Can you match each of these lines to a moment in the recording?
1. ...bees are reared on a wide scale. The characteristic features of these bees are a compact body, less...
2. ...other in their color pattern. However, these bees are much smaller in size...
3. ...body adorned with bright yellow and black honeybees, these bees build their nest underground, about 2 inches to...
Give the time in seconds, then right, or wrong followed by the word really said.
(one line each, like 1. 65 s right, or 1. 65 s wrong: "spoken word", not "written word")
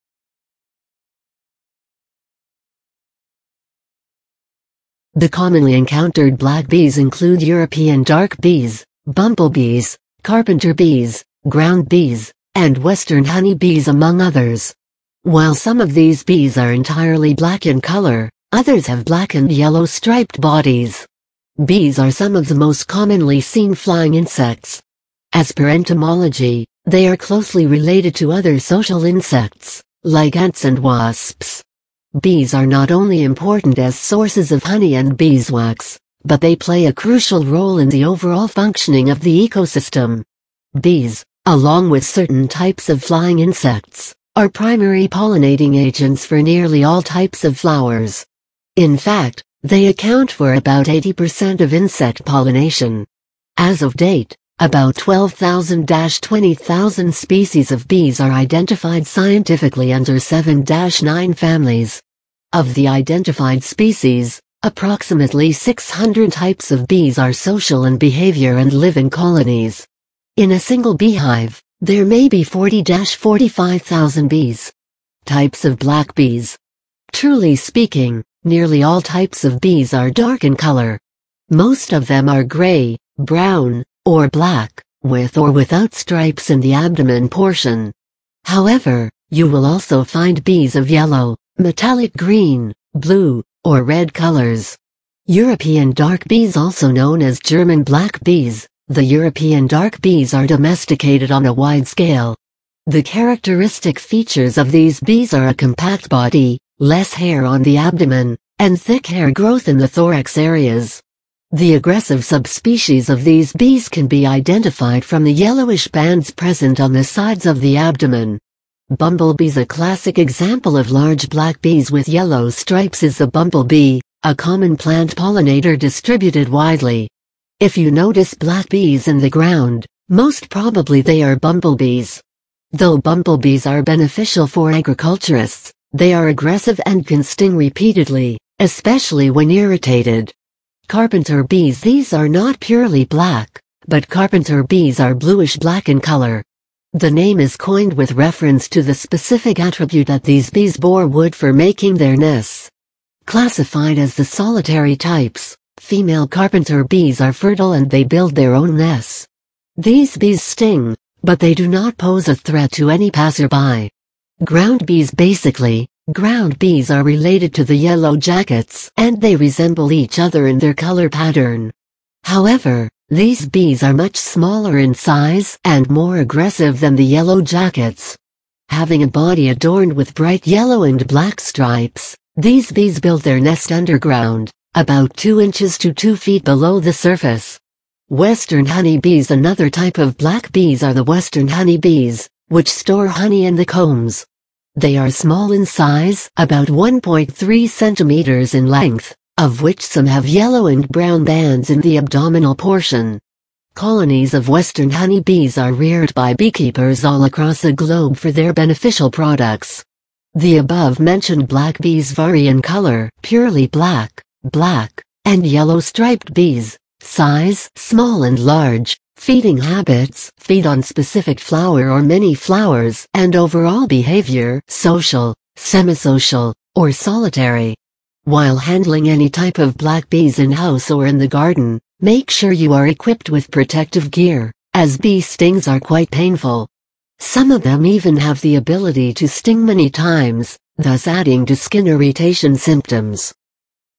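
1. 100 s wrong: "domesticated", not "reared"
2. 170 s right
3. 179 s wrong: "stripes", not "honeybees".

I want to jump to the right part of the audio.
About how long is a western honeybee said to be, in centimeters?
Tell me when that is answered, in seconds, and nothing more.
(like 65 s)
196 s.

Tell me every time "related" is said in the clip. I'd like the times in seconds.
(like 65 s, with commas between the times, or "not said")
27 s, 167 s.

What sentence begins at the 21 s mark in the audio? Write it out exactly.
Bees are some of the most commonly seen flying insects.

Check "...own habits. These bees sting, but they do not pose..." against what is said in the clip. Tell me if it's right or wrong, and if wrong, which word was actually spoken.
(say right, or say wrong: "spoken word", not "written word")
wrong: "nests", not "habits".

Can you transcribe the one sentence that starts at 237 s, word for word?
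Some of them even have the ability to sting many times, thus adding to skin irritation symptoms.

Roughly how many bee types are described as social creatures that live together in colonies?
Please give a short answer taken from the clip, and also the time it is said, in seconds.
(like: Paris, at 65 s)
600, at 65 s.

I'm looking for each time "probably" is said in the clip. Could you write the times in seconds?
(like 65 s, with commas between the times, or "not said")
130 s.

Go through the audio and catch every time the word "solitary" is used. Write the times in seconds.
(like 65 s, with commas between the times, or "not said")
154 s, 226 s.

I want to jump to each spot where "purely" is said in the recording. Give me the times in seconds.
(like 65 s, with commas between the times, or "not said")
142 s, 213 s.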